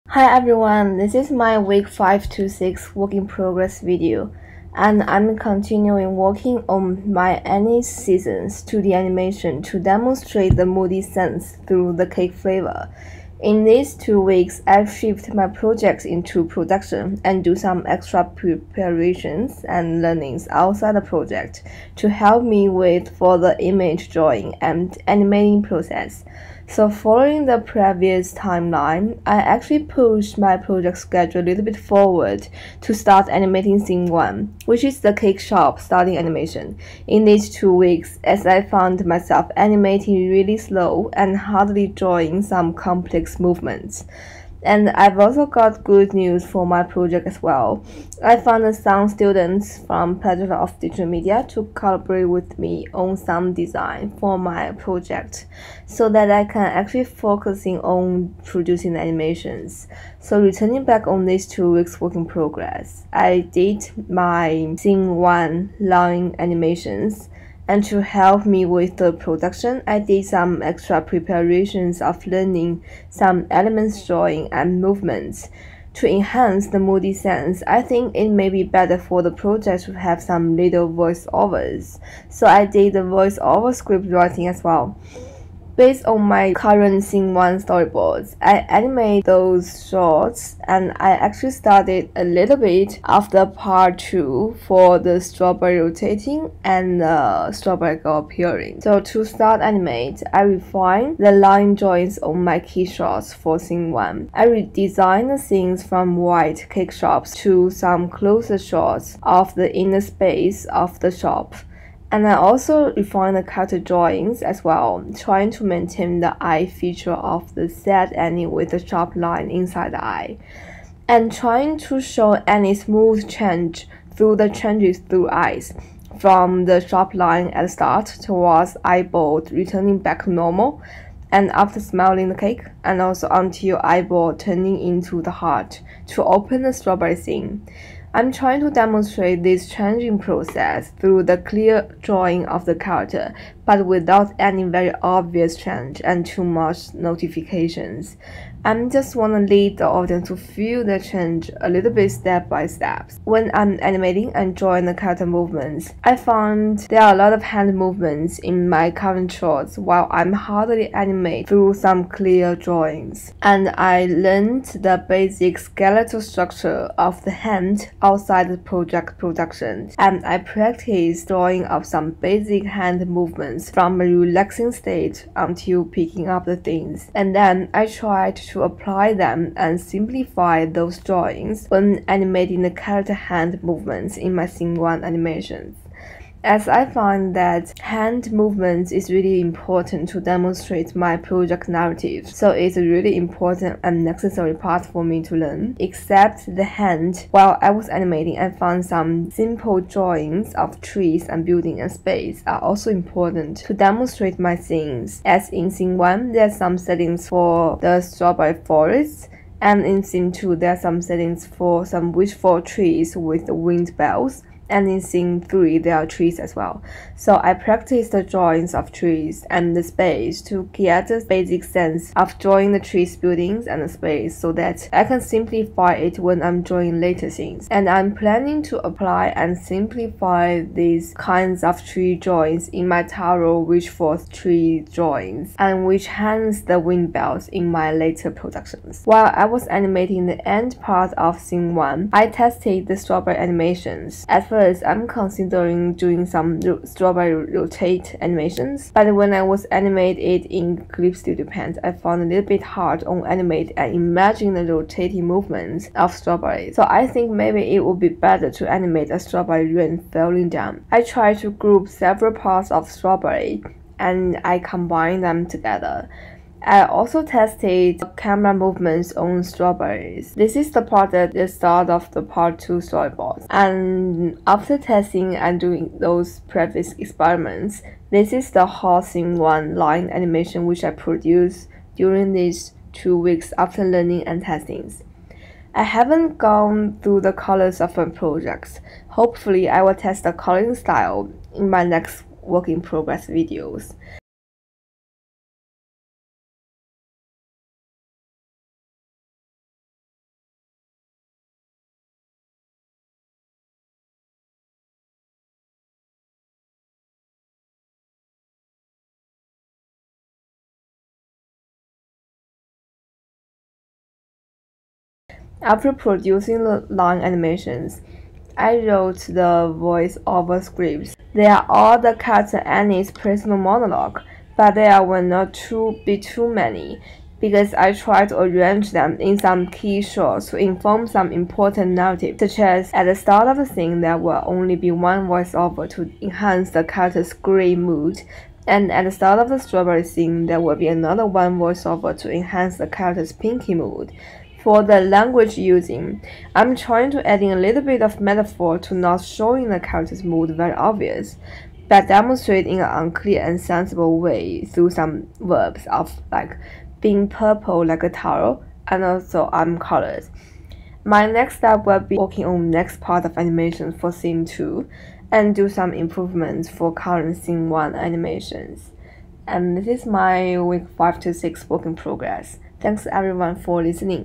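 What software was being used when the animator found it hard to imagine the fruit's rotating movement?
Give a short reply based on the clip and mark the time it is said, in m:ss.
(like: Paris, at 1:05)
Clip Studio Paint, at 4:10.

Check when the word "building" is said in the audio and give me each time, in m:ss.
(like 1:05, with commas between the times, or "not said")
3:21, 3:43.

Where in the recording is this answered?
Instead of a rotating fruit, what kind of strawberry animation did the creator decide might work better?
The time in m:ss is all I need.
4:19.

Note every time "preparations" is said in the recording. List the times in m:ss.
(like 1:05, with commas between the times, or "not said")
0:18, 1:11.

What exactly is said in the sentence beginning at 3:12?
So it's a really important and necessary part for me to learn.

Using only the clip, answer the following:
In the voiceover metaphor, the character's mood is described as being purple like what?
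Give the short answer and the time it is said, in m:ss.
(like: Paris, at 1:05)
A taro, at 5:58.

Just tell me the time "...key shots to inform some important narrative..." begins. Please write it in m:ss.
5:29.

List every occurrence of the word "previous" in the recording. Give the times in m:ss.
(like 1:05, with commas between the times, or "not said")
0:27, 4:36.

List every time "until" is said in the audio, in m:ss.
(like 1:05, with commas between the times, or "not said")
2:13, 2:55.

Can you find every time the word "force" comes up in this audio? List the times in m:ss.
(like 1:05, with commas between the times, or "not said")
3:53.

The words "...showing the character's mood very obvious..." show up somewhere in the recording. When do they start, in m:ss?
5:49.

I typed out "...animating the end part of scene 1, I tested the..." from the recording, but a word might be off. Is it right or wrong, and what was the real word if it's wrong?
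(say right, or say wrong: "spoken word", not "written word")
right.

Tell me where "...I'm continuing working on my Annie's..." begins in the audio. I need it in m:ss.
0:05.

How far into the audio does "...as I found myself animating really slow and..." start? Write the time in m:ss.
0:38.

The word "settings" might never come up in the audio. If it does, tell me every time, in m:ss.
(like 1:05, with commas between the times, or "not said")
3:26, 3:31.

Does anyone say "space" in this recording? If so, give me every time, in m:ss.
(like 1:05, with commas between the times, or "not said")
1:50, 3:21, 3:39, 3:43.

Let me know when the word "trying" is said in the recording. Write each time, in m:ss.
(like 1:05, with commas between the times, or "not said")
1:55, 2:01, 2:18, 5:46.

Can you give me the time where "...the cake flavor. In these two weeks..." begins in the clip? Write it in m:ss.
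0:11.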